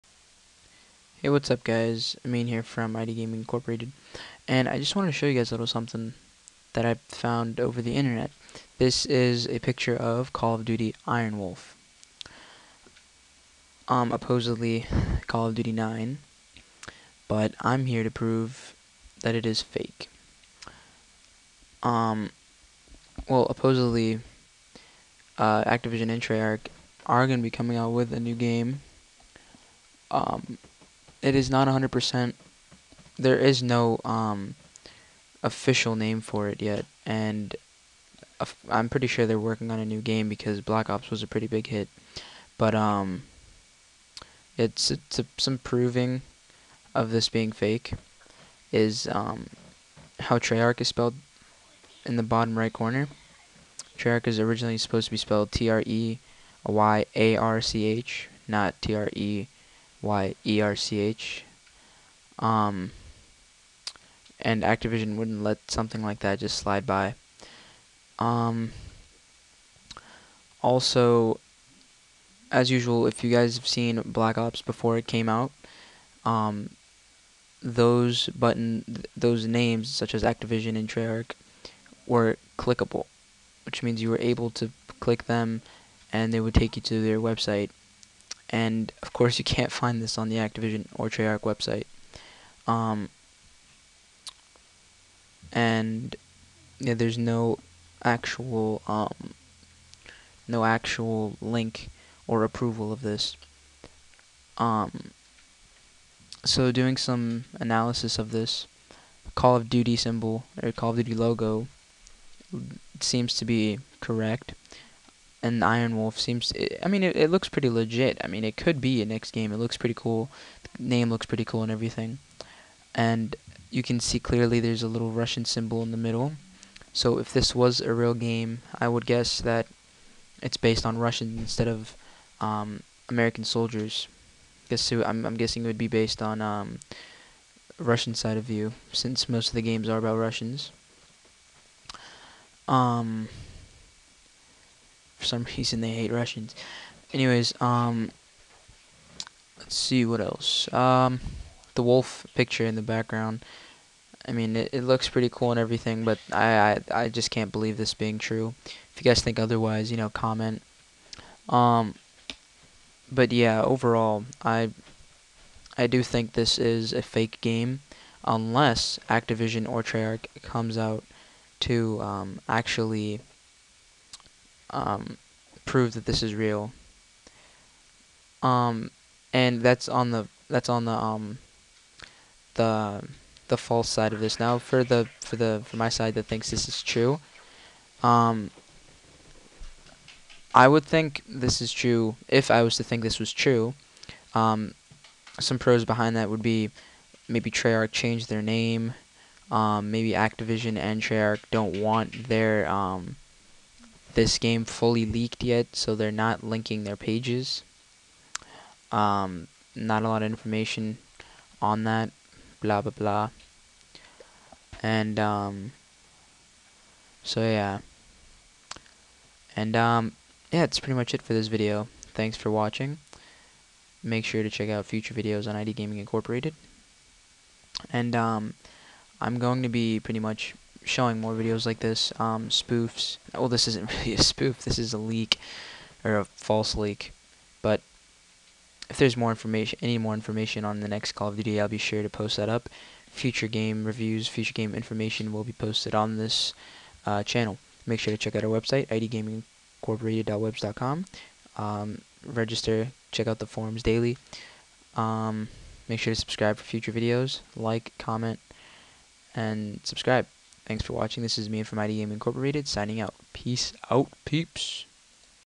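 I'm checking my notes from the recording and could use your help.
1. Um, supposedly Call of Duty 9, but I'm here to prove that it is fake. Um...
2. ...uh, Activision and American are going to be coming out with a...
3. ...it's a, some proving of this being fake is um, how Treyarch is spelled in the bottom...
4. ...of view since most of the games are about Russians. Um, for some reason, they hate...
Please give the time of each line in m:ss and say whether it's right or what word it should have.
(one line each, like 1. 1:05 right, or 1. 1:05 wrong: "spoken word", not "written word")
1. 0:13 right
2. 0:25 wrong: "Treyarch", not "American"
3. 0:44 right
4. 2:18 right.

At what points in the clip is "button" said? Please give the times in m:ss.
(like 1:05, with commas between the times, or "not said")
1:18.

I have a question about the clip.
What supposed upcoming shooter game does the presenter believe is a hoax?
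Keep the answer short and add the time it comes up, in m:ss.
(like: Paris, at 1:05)
Call of Duty Iron Wolf, at 0:10.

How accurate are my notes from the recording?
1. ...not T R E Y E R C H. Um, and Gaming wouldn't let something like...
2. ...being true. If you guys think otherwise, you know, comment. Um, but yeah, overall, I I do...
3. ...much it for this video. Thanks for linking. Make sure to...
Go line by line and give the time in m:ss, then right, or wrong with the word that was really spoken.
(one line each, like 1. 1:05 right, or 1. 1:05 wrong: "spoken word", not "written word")
1. 0:58 wrong: "Activision", not "Gaming"
2. 2:37 right
3. 3:40 wrong: "watching", not "linking".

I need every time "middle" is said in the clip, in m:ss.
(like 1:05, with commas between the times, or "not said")
2:05.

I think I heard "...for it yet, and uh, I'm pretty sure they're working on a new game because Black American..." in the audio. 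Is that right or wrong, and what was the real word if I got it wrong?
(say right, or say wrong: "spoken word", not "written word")
wrong: "Ops", not "American".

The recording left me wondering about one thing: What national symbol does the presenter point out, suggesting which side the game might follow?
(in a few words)
Russian symbol.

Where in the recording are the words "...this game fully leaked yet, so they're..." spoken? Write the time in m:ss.
3:24.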